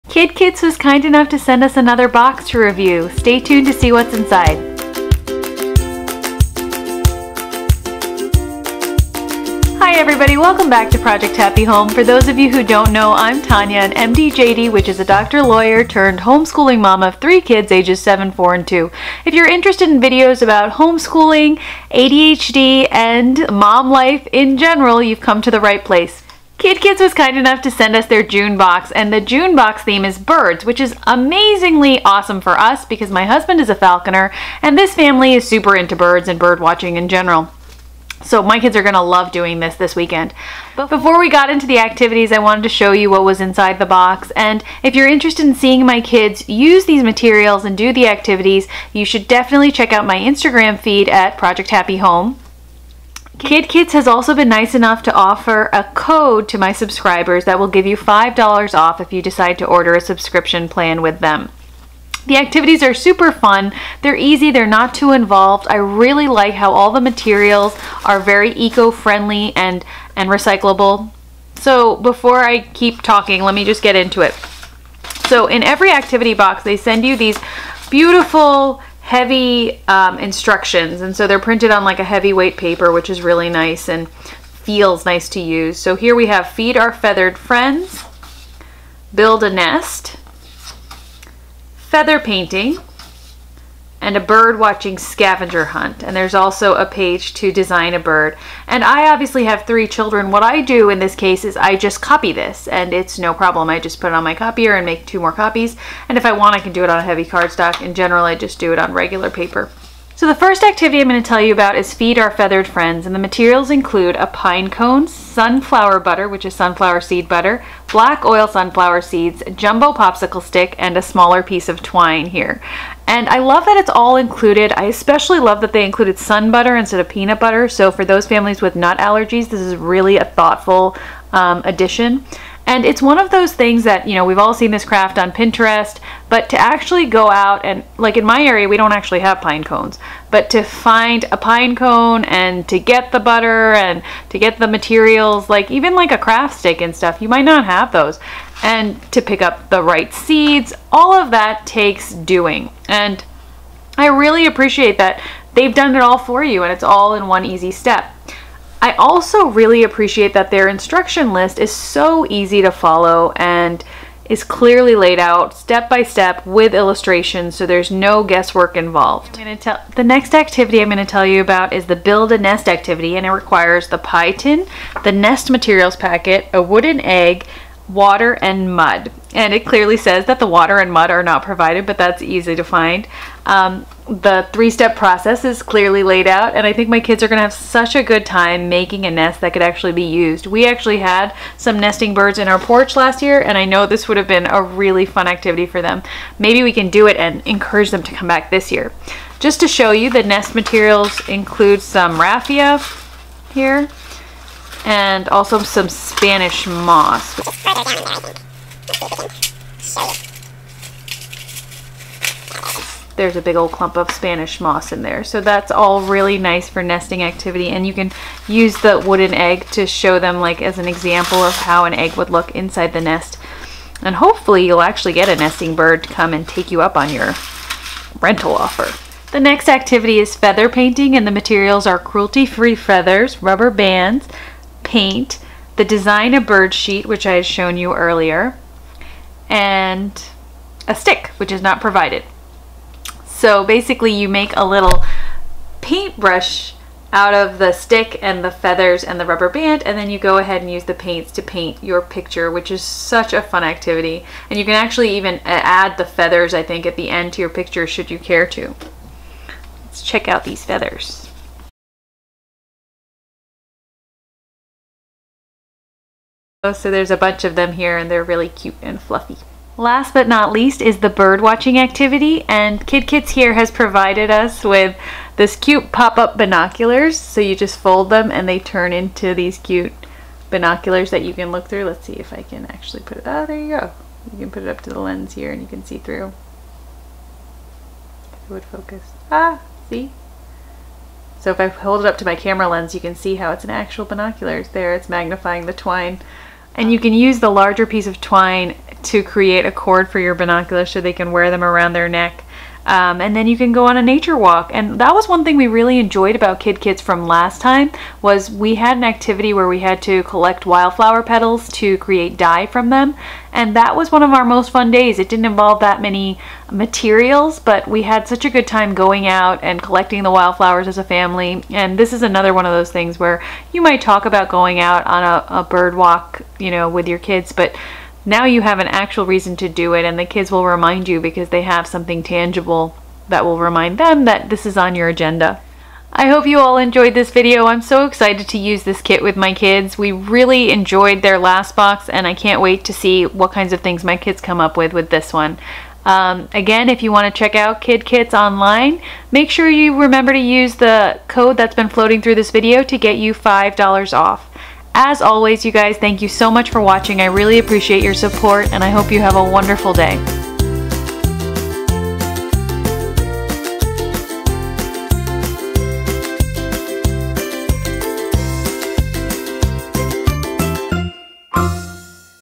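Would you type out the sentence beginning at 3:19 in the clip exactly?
Just to show you, the nest materials include some raffia here, and also some Spanish moss.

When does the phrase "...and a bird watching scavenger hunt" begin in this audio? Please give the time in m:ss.
1:34.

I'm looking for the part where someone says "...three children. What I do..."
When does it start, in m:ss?
1:39.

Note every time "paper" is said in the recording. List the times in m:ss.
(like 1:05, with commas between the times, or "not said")
1:22, 1:49.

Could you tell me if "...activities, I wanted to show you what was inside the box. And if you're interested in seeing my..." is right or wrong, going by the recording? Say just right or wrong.
right.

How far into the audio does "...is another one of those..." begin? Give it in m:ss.
5:22.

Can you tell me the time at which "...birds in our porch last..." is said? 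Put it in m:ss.
3:12.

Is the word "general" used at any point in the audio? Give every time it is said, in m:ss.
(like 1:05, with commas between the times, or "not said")
0:24, 0:37, 1:47.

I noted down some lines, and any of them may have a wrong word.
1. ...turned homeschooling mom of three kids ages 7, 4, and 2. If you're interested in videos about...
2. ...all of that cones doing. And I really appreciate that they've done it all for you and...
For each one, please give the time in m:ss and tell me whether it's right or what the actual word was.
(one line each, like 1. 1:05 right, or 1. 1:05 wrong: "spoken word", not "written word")
1. 0:15 right
2. 2:30 wrong: "takes", not "cones".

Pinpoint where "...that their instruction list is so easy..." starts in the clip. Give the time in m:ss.
2:40.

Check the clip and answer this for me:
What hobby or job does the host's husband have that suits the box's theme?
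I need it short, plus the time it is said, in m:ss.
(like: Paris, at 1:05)
Falconer, at 0:33.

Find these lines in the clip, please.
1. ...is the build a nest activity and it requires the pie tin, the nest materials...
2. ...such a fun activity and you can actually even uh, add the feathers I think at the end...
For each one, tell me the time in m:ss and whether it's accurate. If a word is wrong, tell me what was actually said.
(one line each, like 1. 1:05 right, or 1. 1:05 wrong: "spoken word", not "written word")
1. 2:51 right
2. 4:12 right.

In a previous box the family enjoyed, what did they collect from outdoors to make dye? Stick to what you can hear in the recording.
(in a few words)
Wildflower petals.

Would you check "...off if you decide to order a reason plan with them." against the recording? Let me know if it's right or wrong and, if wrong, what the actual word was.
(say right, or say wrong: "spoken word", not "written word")
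wrong: "subscription", not "reason".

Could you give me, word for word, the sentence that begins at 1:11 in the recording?
So before I keep talking, let me just get into it.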